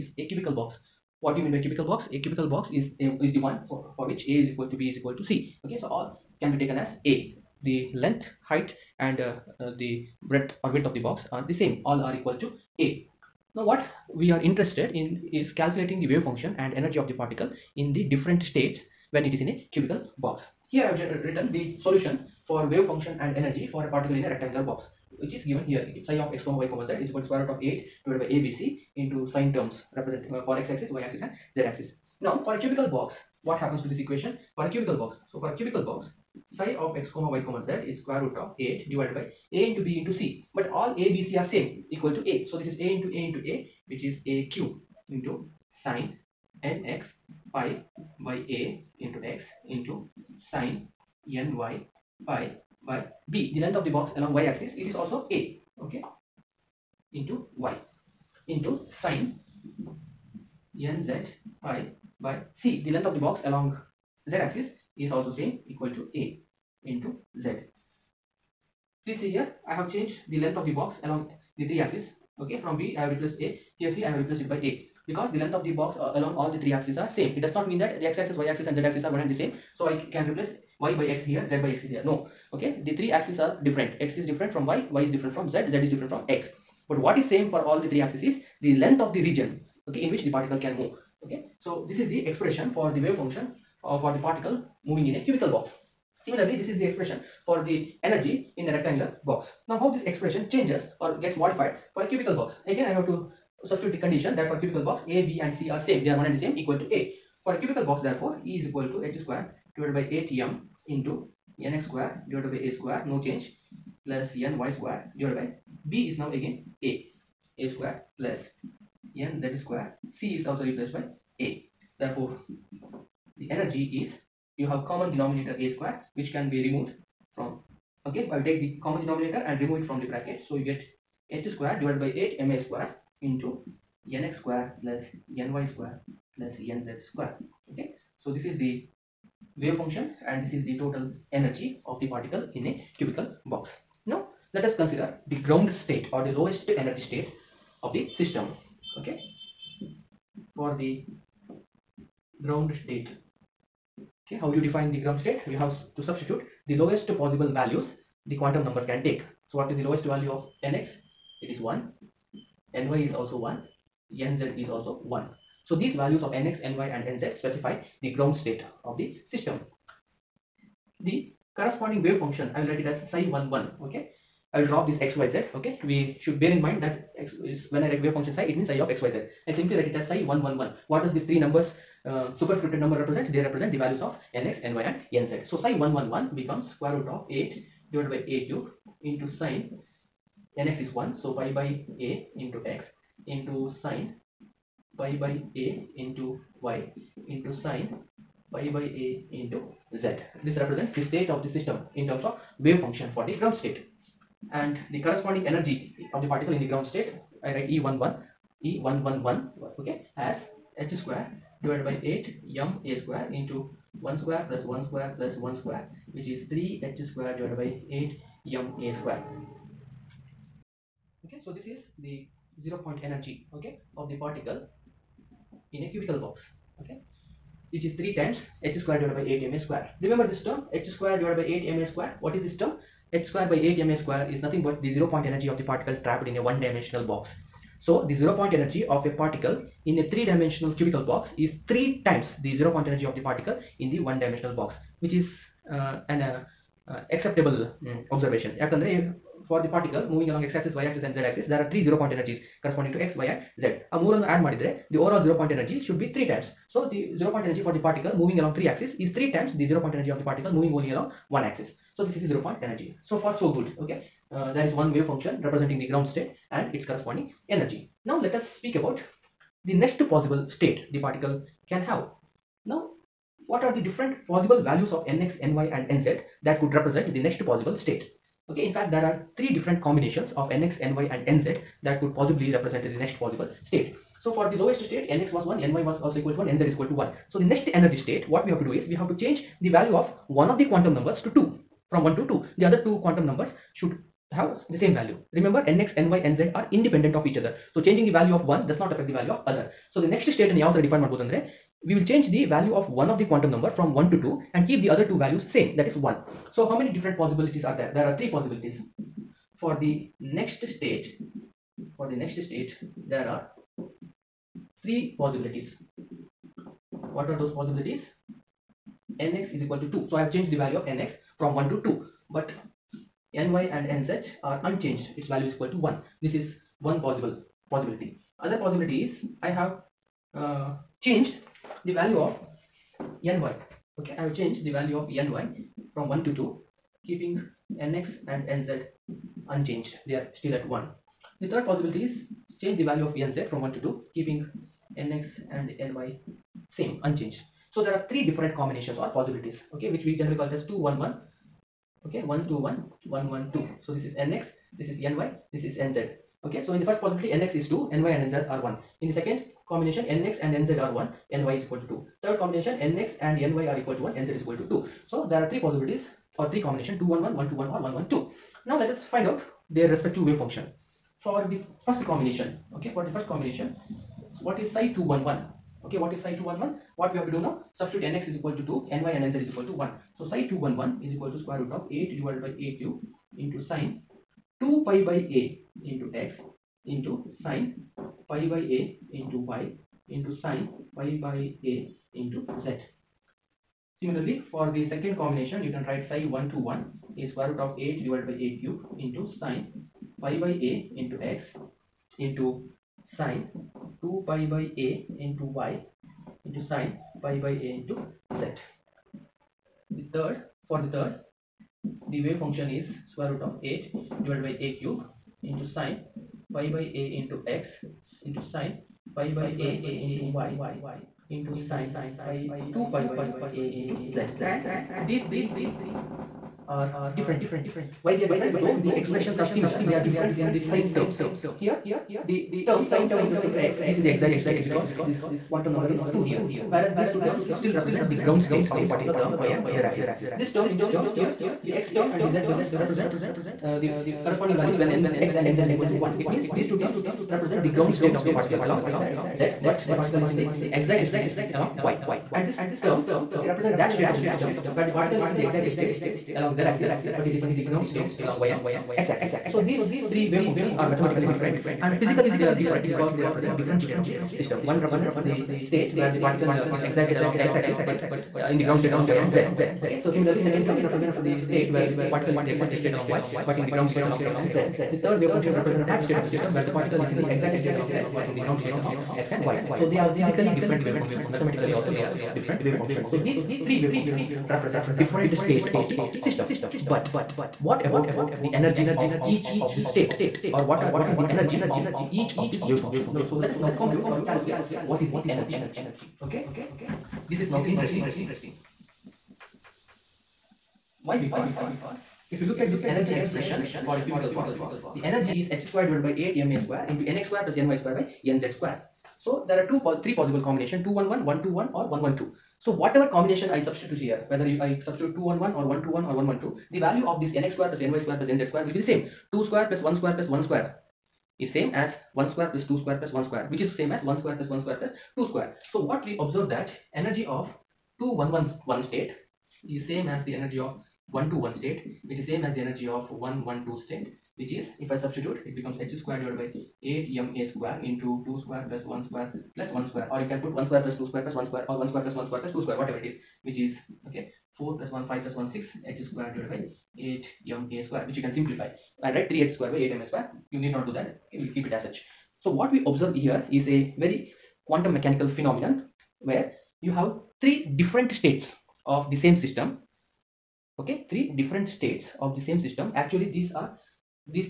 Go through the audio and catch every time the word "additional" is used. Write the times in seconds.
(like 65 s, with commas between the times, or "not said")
not said.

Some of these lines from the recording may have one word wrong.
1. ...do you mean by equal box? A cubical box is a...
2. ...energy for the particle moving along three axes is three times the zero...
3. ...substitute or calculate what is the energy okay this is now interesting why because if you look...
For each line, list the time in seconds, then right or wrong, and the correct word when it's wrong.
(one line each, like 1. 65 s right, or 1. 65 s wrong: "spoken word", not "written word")
1. 1 s wrong: "cubical", not "equal"
2. 257 s right
3. 493 s wrong: "compute", not "substitute".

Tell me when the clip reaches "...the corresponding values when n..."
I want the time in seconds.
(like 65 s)
443 s.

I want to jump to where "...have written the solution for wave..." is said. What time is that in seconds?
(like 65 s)
20 s.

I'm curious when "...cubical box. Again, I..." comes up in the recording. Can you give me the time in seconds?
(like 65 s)
102 s.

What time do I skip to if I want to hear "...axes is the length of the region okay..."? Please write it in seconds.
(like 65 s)
87 s.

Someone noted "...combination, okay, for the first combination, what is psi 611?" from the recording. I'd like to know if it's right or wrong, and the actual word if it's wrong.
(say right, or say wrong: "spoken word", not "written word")
wrong: "211", not "611".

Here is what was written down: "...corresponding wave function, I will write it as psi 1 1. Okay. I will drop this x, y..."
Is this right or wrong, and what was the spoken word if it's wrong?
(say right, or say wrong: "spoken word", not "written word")
right.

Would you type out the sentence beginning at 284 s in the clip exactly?
So for the lowest state nx was 1, ny was also equal to 1, nz is equal to 1.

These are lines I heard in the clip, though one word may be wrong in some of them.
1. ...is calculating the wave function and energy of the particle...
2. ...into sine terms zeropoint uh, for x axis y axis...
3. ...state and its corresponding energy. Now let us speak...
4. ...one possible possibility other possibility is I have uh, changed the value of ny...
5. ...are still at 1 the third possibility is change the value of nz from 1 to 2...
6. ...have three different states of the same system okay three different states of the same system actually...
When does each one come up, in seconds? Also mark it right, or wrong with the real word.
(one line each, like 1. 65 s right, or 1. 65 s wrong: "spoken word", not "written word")
1. 15 s right
2. 28 s wrong: "represent", not "zeropoint"
3. 266 s right
4. 326 s right
5. 340 s right
6. 556 s right.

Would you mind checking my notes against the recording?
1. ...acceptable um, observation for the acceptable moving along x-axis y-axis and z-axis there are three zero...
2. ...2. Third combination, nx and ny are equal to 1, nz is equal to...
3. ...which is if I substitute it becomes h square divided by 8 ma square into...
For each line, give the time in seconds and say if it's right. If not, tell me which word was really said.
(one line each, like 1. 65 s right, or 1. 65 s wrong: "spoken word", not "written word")
1. 247 s wrong: "particle", not "acceptable"
2. 361 s right
3. 534 s right.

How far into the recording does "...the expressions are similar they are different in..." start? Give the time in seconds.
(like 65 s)
428 s.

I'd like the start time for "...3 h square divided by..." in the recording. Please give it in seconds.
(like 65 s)
216 s.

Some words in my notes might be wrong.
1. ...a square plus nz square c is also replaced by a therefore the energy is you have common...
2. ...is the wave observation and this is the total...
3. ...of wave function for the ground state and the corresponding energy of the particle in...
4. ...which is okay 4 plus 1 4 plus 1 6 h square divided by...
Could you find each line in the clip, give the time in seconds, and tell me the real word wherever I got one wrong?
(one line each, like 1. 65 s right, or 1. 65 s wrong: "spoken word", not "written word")
1. 117 s right
2. 138 s wrong: "function", not "observation"
3. 202 s right
4. 543 s wrong: "5", not "4".